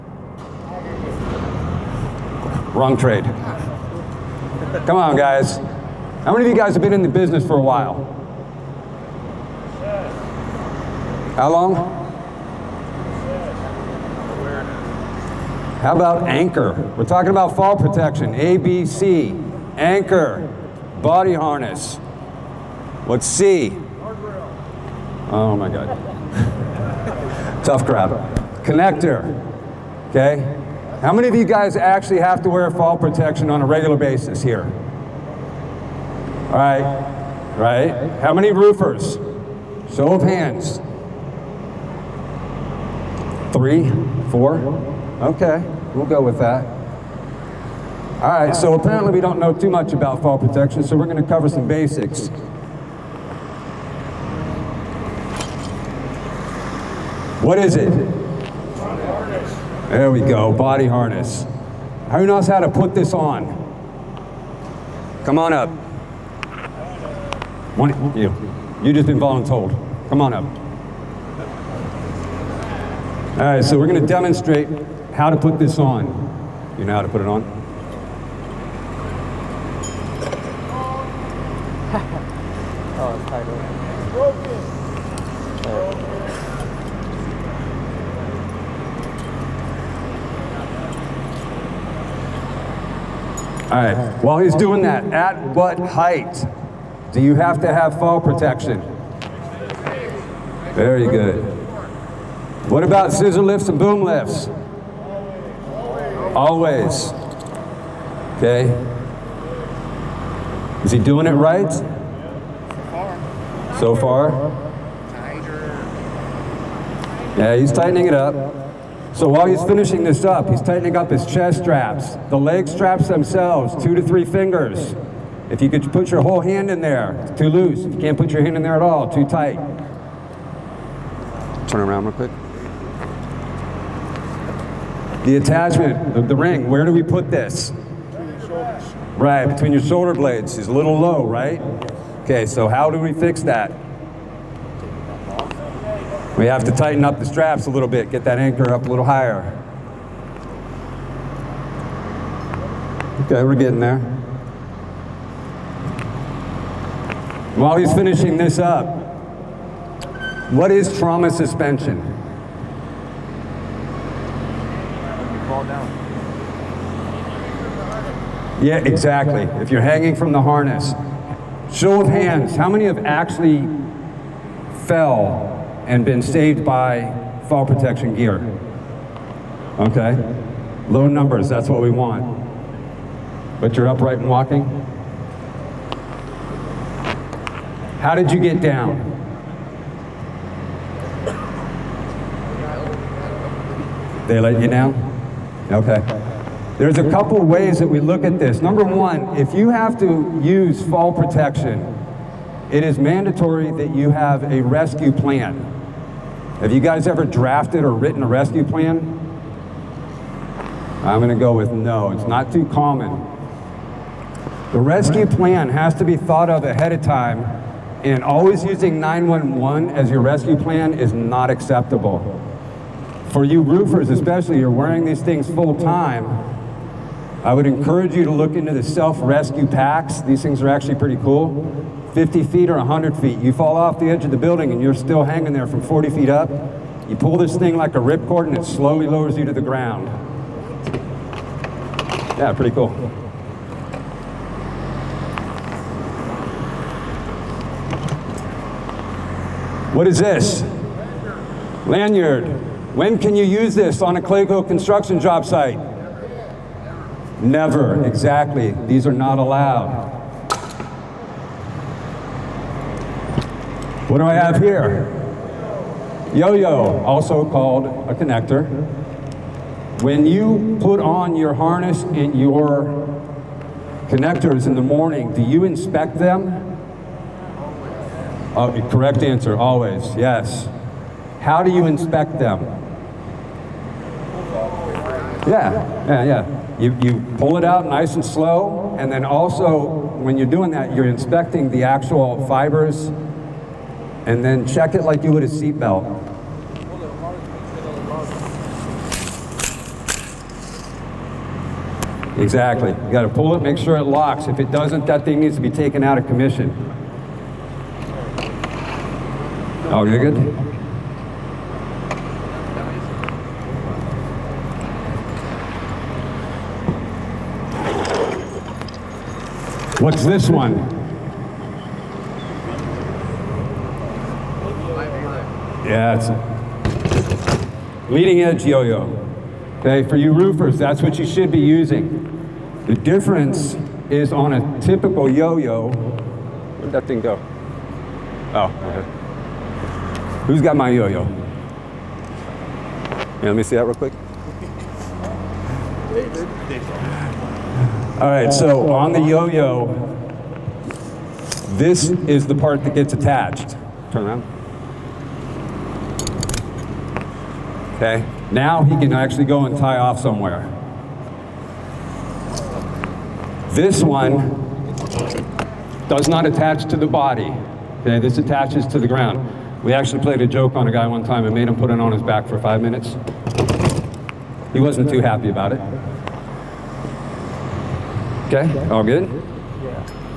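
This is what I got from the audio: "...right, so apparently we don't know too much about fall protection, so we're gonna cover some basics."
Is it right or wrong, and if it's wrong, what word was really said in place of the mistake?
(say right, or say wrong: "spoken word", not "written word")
right.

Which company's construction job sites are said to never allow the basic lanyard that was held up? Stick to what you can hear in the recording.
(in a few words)
Clayco.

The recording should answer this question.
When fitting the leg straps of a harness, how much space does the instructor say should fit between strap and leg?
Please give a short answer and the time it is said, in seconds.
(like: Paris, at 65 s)
2 to 3 fingers, at 123 s.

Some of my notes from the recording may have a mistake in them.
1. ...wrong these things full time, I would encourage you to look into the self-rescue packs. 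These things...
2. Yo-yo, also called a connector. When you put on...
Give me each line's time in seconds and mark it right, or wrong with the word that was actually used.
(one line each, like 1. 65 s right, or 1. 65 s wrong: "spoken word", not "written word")
1. 224 s wrong: "wearing", not "wrong"
2. 266 s right.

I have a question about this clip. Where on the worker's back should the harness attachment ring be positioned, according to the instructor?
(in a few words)
Between your shoulder blades.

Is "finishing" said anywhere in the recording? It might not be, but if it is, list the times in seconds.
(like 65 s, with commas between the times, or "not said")
119 s, 157 s.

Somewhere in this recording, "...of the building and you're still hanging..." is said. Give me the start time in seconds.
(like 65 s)
234 s.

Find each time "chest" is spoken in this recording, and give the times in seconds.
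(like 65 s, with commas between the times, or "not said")
121 s.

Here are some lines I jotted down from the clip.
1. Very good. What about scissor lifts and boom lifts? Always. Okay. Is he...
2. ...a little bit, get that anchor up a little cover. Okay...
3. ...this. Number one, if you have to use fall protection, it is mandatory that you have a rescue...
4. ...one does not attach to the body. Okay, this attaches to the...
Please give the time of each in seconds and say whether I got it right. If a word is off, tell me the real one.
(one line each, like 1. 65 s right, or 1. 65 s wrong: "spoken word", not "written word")
1. 100 s right
2. 147 s wrong: "higher", not "cover"
3. 198 s right
4. 364 s right.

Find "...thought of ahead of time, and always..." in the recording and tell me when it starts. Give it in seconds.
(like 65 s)
216 s.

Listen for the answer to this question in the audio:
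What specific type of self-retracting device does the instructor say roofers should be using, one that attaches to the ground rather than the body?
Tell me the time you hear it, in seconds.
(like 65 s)
328 s.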